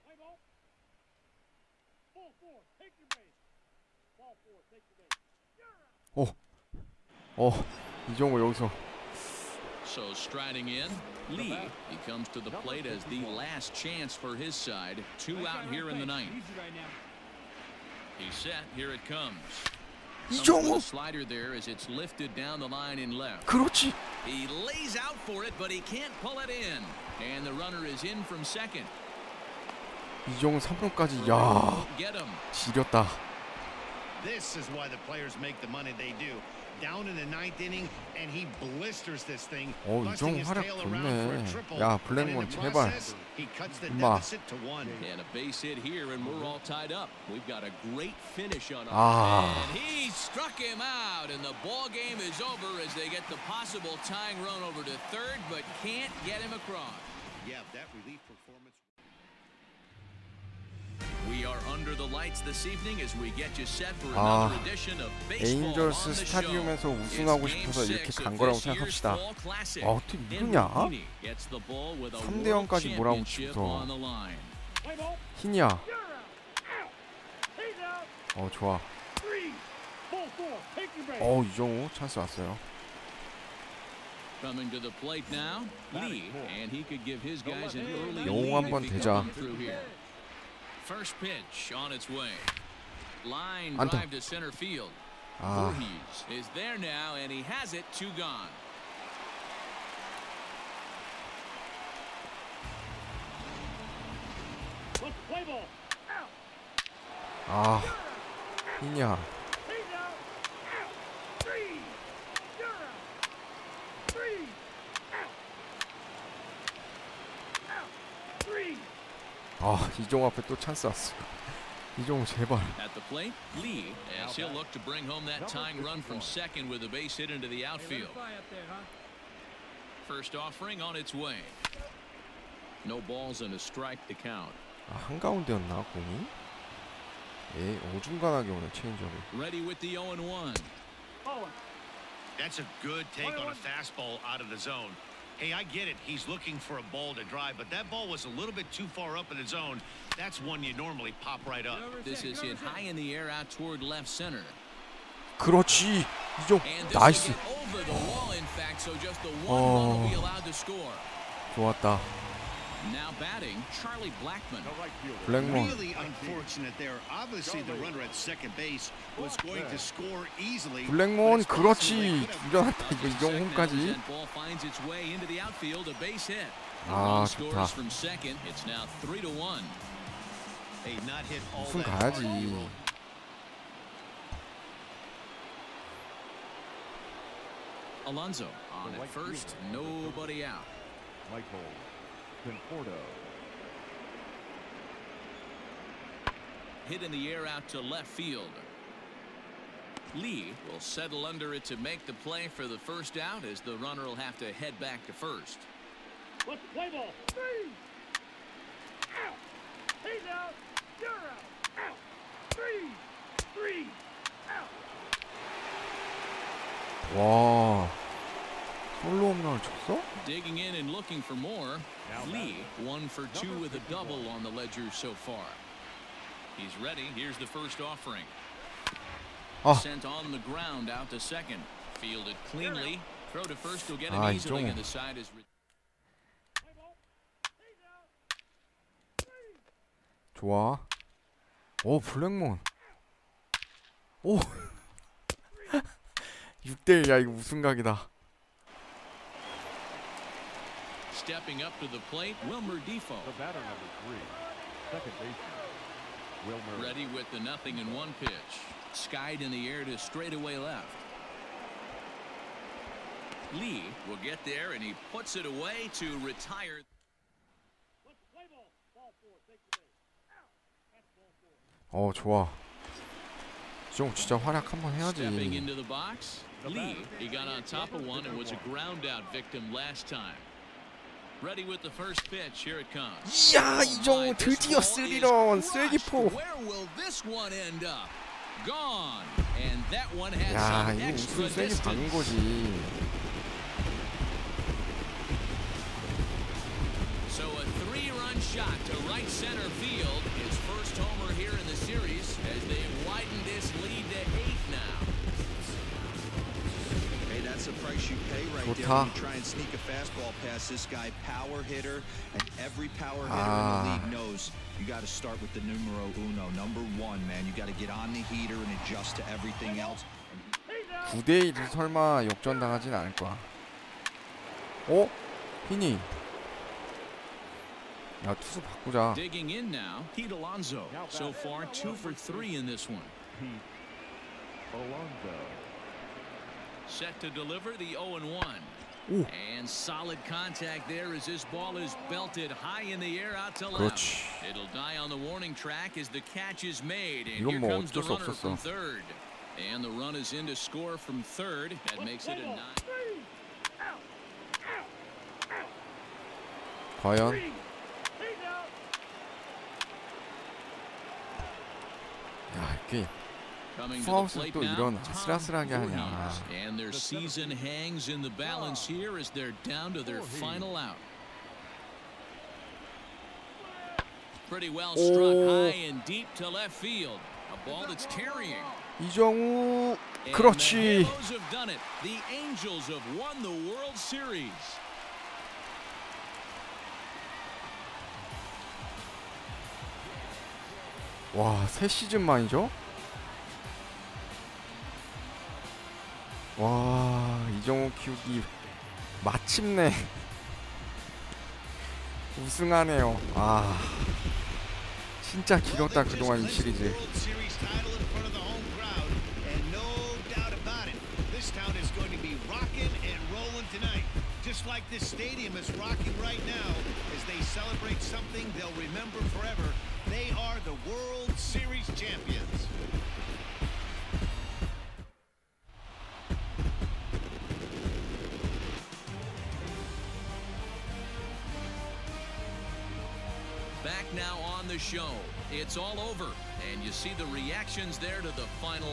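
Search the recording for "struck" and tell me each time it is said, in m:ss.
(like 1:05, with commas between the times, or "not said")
0:50, 6:14.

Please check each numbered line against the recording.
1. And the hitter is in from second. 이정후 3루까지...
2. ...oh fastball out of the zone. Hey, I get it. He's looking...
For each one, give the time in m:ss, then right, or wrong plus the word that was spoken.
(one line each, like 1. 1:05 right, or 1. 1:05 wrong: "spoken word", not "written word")
1. 0:27 wrong: "runner", not "hitter"
2. 2:23 right.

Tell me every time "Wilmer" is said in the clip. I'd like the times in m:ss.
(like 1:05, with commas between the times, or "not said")
4:12, 4:16.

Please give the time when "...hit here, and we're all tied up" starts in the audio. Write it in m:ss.
0:45.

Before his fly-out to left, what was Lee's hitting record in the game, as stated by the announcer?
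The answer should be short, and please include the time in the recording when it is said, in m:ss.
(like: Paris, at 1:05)
one for two, at 3:42.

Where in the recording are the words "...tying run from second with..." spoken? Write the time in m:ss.
2:05.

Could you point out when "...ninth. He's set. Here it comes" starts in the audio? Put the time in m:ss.
0:16.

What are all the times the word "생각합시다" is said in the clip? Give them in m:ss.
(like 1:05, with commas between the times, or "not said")
1:08.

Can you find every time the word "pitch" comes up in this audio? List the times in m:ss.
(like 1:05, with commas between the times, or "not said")
1:31, 4:18.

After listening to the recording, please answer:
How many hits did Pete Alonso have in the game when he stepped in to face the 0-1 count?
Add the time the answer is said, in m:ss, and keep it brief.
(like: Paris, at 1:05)
two for three, at 5:31.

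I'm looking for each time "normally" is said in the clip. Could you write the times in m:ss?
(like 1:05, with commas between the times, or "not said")
2:30.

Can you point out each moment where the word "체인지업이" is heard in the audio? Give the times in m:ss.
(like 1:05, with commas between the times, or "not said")
2:18.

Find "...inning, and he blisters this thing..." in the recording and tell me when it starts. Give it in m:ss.
0:37.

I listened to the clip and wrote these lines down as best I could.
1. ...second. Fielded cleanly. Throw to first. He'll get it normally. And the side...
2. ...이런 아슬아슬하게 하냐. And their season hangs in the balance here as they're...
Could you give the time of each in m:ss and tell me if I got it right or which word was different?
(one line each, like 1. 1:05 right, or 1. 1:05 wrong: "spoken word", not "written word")
1. 3:51 wrong: "easily", not "normally"
2. 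6:04 right.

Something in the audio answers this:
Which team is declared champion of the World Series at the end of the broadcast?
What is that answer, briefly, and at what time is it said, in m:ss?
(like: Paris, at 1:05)
Angels, at 6:22.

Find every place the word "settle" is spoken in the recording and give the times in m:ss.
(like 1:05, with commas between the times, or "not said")
3:20.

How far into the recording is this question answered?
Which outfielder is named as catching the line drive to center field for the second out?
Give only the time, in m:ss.
1:35.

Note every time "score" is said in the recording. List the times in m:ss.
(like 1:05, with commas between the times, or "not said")
2:49, 5:50.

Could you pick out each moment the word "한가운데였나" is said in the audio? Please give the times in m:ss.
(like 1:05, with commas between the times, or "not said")
2:15.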